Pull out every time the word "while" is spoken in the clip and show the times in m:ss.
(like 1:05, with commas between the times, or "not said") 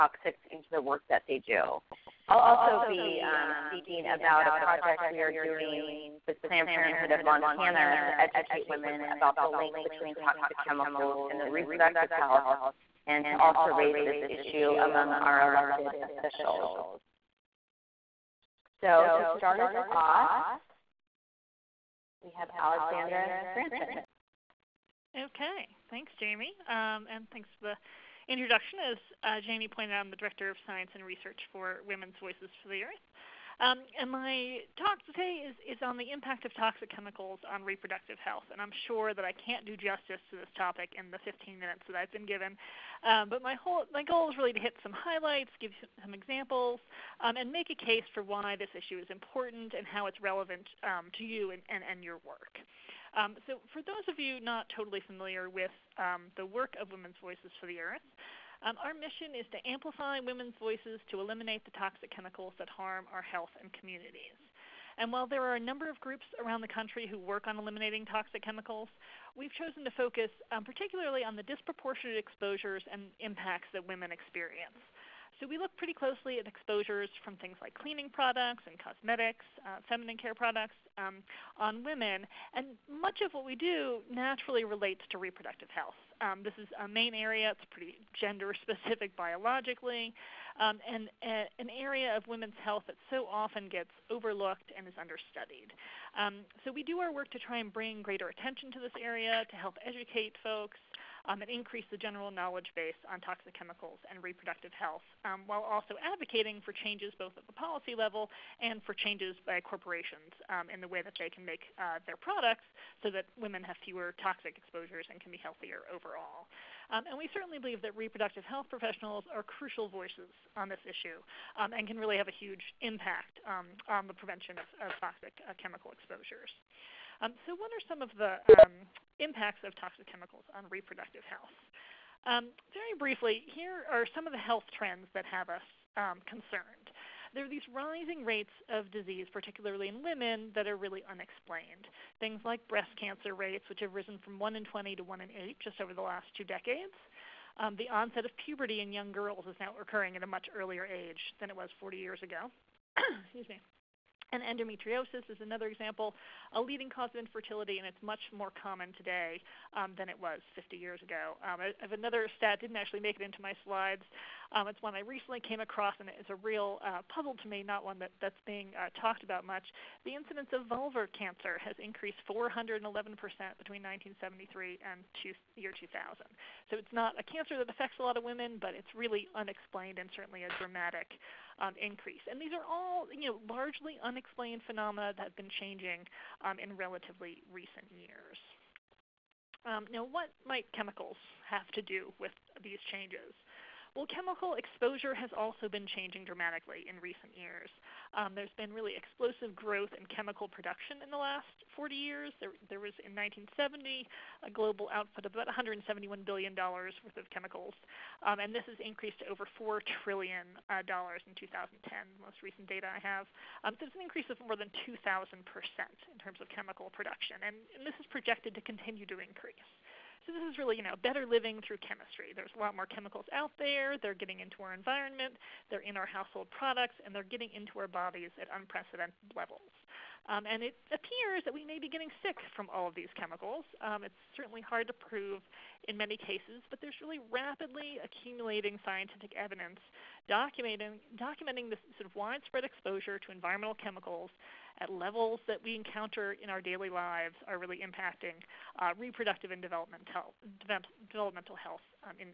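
1:05, 1:45.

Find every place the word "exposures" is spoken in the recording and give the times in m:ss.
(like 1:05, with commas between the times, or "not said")
1:12, 1:16, 1:54, 2:05, 3:14, 4:02.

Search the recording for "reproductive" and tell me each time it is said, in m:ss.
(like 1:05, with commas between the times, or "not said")
0:11, 0:37, 1:25, 1:44, 1:57, 2:10, 4:08.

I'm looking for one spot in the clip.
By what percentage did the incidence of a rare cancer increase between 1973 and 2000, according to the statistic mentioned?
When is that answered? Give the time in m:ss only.
2:52.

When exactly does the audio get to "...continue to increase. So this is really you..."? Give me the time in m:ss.
3:38.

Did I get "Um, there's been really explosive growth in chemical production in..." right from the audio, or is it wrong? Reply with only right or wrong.
right.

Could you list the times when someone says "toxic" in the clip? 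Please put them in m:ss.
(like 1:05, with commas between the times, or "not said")
0:10, 0:36, 1:01, 1:08, 1:43, 1:54, 2:04, 2:09.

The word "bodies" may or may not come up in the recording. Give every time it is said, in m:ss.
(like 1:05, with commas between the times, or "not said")
3:47.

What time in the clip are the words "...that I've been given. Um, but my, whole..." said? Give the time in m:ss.
0:41.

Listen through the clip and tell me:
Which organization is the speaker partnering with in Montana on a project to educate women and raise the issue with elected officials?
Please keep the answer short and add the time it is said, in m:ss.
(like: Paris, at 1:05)
Planned Parenthood, at 0:06.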